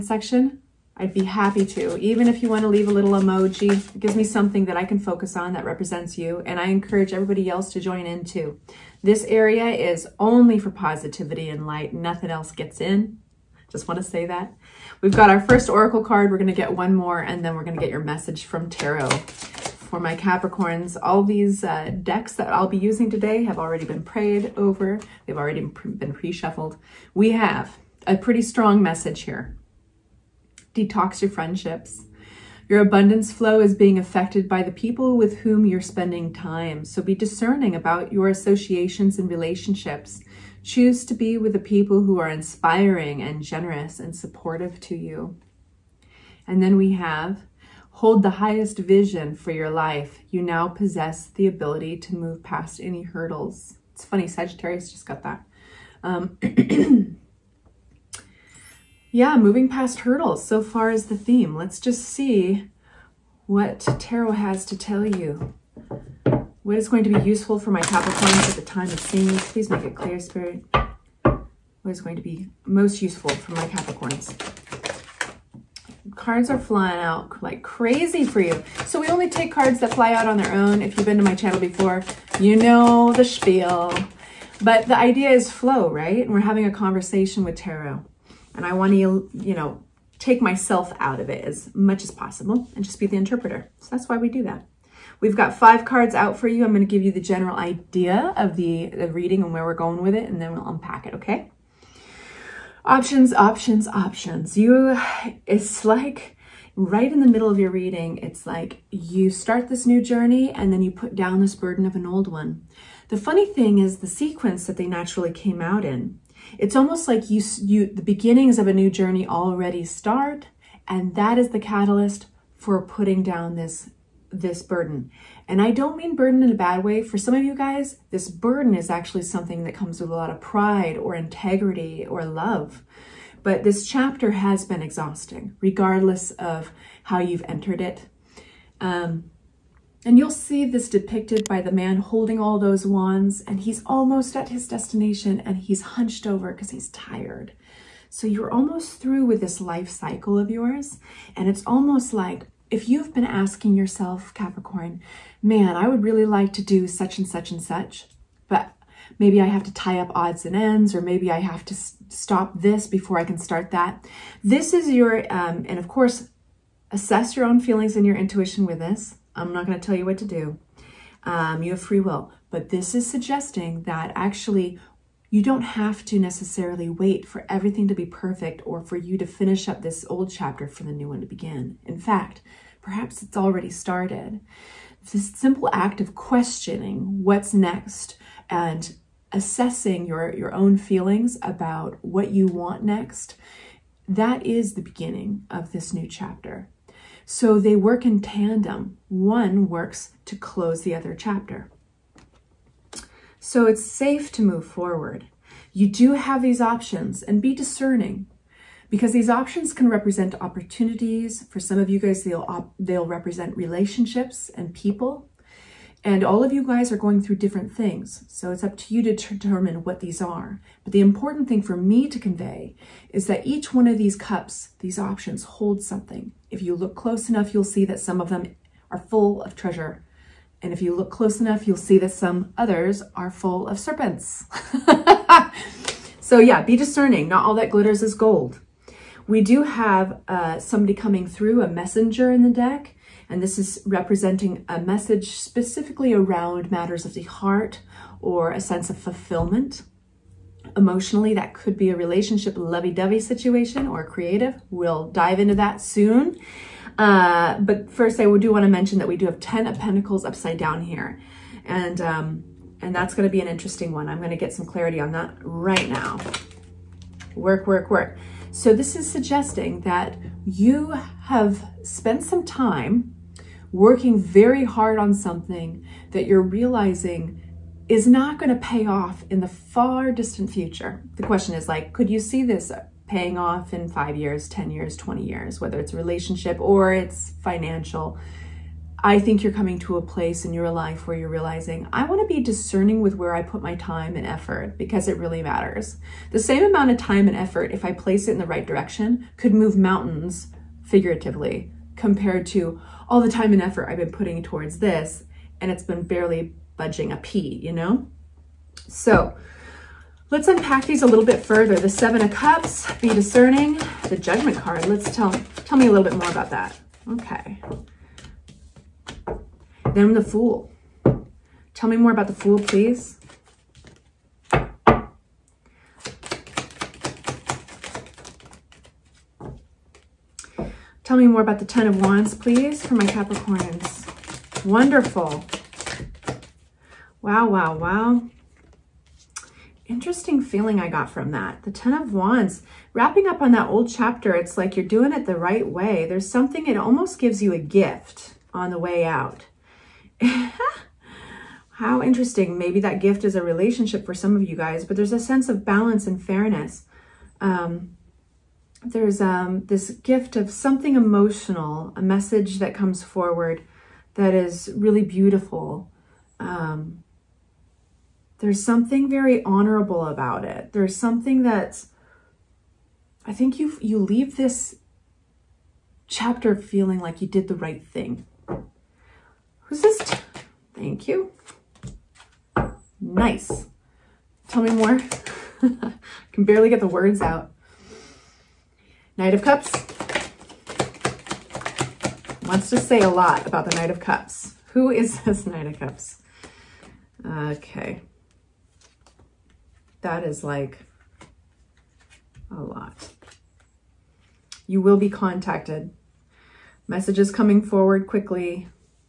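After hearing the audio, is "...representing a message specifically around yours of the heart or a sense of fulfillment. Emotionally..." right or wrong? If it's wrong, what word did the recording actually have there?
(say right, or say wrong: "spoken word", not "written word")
wrong: "matters", not "yours".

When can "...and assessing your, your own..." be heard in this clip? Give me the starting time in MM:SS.
03:08.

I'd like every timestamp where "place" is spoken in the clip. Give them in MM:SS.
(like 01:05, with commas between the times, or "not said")
04:50, 04:57.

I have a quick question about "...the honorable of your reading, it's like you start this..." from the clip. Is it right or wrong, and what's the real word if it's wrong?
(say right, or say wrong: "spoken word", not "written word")
wrong: "middle", not "honorable".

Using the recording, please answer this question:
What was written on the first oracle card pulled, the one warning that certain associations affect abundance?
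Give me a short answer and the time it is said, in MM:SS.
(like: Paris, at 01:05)
Detox your friendships, at 00:30.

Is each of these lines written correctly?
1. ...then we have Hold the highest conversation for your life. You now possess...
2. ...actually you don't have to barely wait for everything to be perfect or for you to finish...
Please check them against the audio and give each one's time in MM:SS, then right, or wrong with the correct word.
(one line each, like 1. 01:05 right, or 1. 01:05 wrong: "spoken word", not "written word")
1. 00:46 wrong: "vision", not "conversation"
2. 02:54 wrong: "necessarily", not "barely".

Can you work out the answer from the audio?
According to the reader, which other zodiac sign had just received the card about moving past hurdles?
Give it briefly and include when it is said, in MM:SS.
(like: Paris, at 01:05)
Sagittarius, at 00:54.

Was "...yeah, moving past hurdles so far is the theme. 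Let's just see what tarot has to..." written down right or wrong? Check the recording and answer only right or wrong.
right.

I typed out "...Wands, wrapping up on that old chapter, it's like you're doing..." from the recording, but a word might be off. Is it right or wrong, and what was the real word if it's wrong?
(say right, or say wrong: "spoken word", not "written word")
right.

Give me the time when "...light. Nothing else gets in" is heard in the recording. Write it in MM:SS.
00:11.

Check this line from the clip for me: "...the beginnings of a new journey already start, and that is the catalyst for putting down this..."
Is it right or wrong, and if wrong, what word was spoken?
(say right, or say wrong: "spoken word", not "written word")
right.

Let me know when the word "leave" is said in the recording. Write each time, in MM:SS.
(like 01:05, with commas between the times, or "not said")
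00:02, 06:13.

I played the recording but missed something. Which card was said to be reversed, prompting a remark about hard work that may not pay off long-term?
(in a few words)
10 of pentacles.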